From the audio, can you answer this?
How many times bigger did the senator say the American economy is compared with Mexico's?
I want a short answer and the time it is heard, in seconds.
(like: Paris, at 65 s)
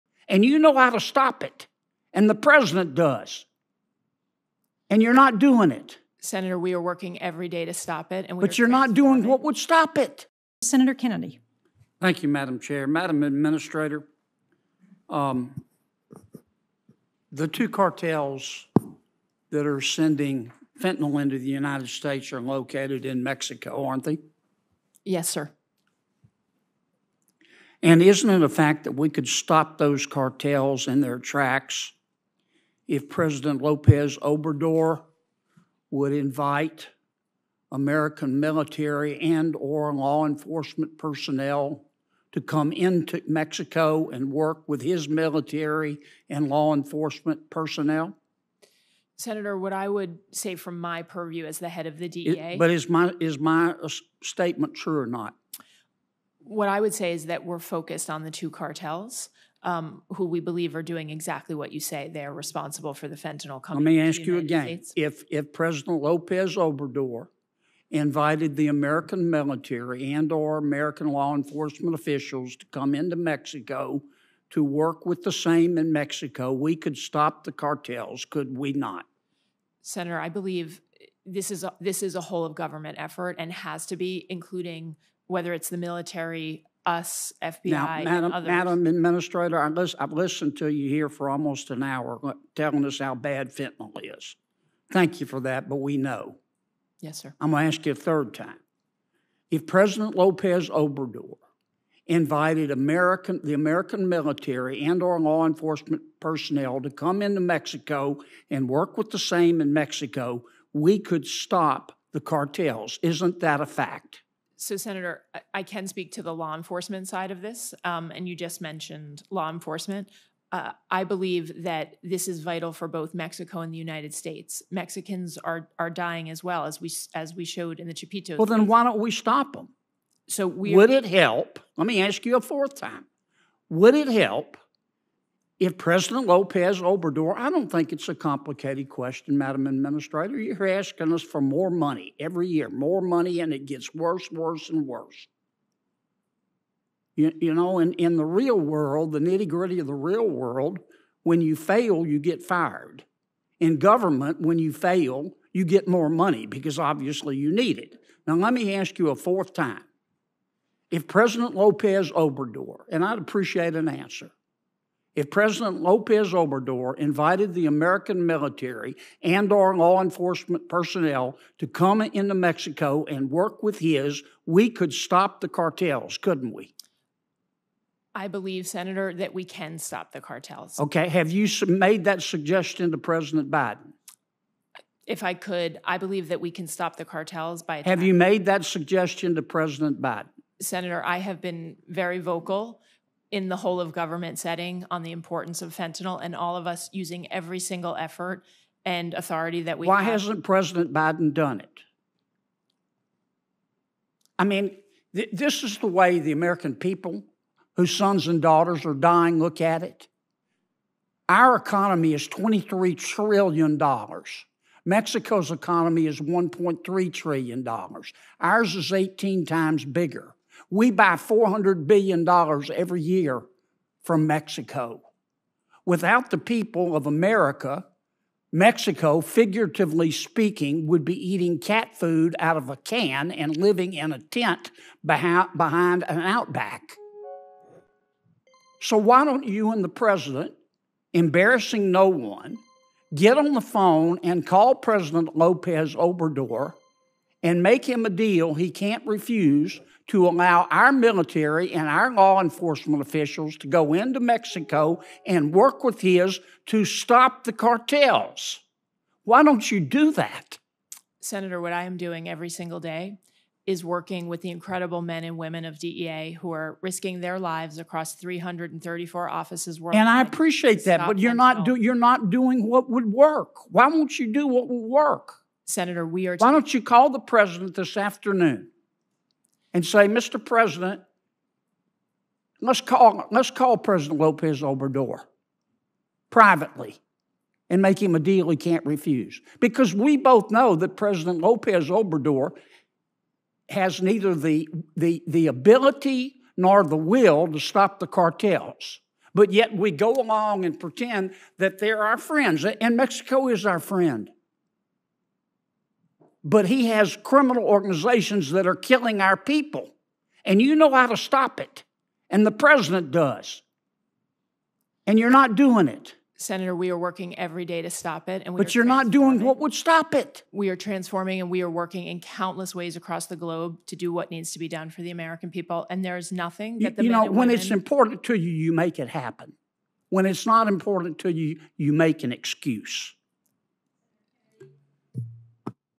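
18 times, at 218 s.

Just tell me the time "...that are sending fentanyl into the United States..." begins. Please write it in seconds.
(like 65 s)
19 s.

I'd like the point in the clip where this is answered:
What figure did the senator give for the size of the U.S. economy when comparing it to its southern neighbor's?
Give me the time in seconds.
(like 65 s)
212 s.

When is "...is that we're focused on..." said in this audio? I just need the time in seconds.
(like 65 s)
57 s.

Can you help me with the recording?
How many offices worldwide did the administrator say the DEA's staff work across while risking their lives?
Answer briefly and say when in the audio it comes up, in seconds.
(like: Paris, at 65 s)
334, at 268 s.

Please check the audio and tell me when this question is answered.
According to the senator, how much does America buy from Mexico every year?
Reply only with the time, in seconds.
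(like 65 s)
221 s.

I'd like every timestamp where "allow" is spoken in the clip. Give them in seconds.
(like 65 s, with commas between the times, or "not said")
250 s.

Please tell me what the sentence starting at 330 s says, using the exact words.
When it's not important to you, you make an excuse.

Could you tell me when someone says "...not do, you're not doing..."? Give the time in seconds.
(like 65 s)
271 s.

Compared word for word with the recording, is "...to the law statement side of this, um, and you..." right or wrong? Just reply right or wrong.
wrong.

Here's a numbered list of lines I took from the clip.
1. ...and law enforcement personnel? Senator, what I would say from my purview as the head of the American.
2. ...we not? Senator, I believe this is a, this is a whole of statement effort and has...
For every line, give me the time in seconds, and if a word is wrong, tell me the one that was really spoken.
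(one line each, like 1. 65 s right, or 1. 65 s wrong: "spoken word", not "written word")
1. 46 s wrong: "DEA", not "American"
2. 78 s wrong: "government", not "statement".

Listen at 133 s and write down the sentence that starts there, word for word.
Would it help if President Lopez Obrador, I don't think it's a complicated question, Madam Administrator.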